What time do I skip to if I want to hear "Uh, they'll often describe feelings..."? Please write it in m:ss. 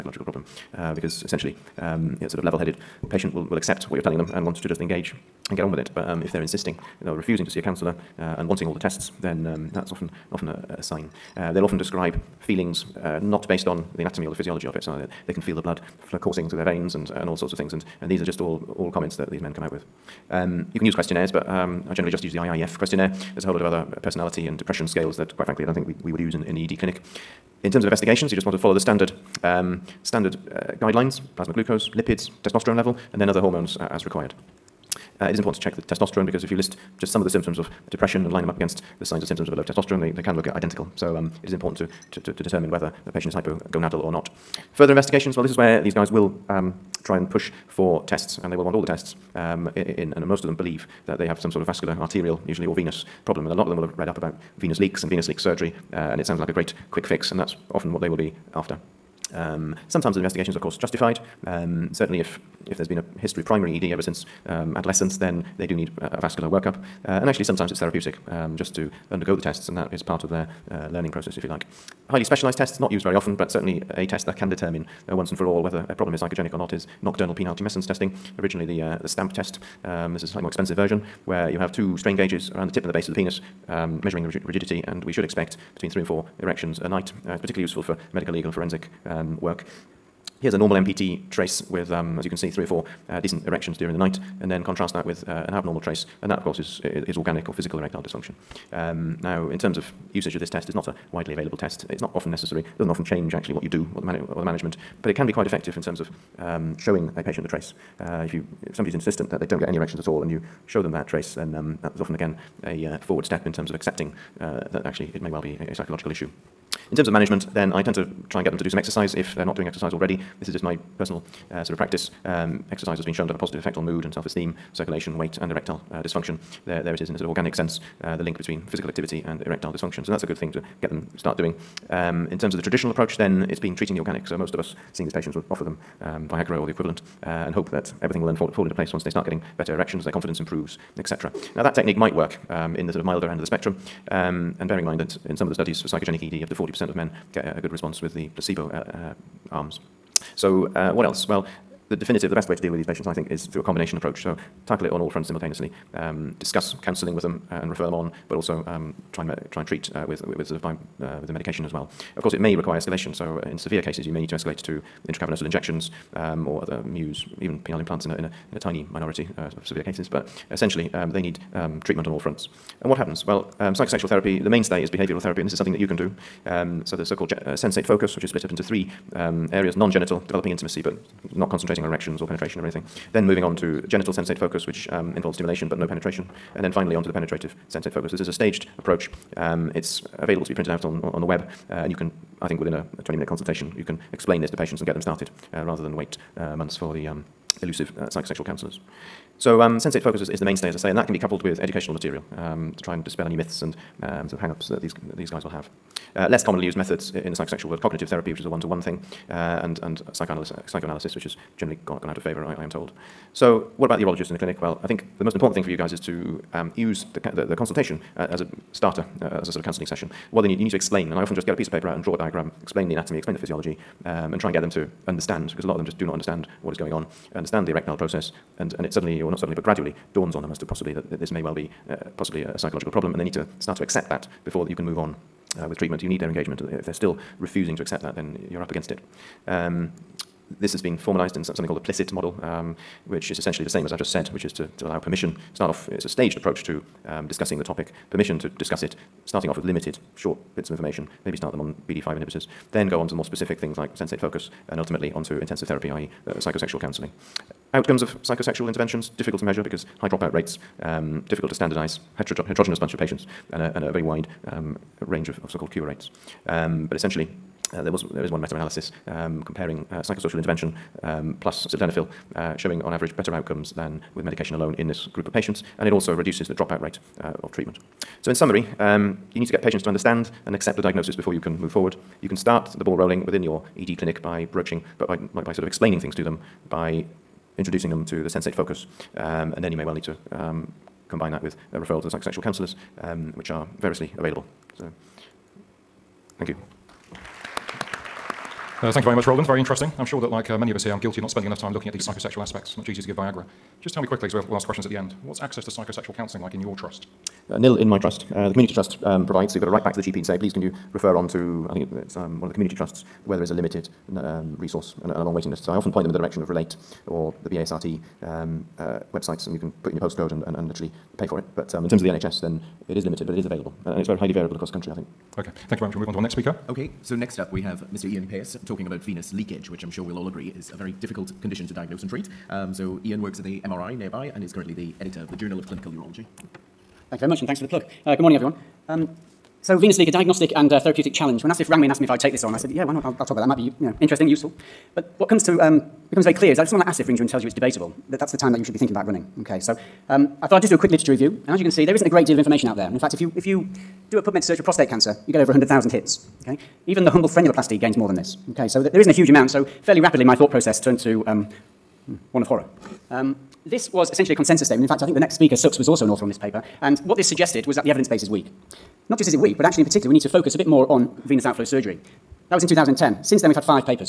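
0:11.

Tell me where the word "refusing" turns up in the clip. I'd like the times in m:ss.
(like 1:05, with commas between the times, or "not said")
0:07, 3:57.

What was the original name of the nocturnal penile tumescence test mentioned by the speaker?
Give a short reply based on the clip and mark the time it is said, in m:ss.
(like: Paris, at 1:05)
STAMP test, at 1:19.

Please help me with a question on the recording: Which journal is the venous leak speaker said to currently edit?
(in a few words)
Journal of Clinical Urology.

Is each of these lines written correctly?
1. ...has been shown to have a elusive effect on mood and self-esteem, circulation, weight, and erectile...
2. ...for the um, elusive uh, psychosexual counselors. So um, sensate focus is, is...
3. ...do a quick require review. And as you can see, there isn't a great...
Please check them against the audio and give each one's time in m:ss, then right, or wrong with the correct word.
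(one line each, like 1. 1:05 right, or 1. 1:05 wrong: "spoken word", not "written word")
1. 2:02 wrong: "positive", not "elusive"
2. 3:16 right
3. 5:50 wrong: "literature", not "require".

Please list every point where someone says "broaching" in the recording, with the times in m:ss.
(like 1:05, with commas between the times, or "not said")
4:44.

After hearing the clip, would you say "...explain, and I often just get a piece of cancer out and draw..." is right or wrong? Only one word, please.
wrong.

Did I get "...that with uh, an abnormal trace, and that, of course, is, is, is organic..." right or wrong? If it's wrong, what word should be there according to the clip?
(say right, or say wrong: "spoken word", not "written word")
right.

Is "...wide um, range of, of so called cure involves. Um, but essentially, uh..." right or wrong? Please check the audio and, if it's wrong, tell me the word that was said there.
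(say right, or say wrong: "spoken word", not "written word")
wrong: "rates", not "involves".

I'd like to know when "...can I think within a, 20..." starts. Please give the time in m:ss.
3:11.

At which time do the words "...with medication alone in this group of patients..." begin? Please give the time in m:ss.
4:34.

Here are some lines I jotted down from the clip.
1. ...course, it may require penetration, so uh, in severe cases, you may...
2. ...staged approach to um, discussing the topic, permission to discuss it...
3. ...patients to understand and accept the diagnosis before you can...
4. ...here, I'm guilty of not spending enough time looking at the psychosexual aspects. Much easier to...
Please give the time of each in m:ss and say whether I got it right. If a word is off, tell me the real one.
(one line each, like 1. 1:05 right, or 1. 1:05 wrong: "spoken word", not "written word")
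1. 2:42 wrong: "escalation", not "penetration"
2. 4:06 right
3. 4:39 right
4. 5:00 right.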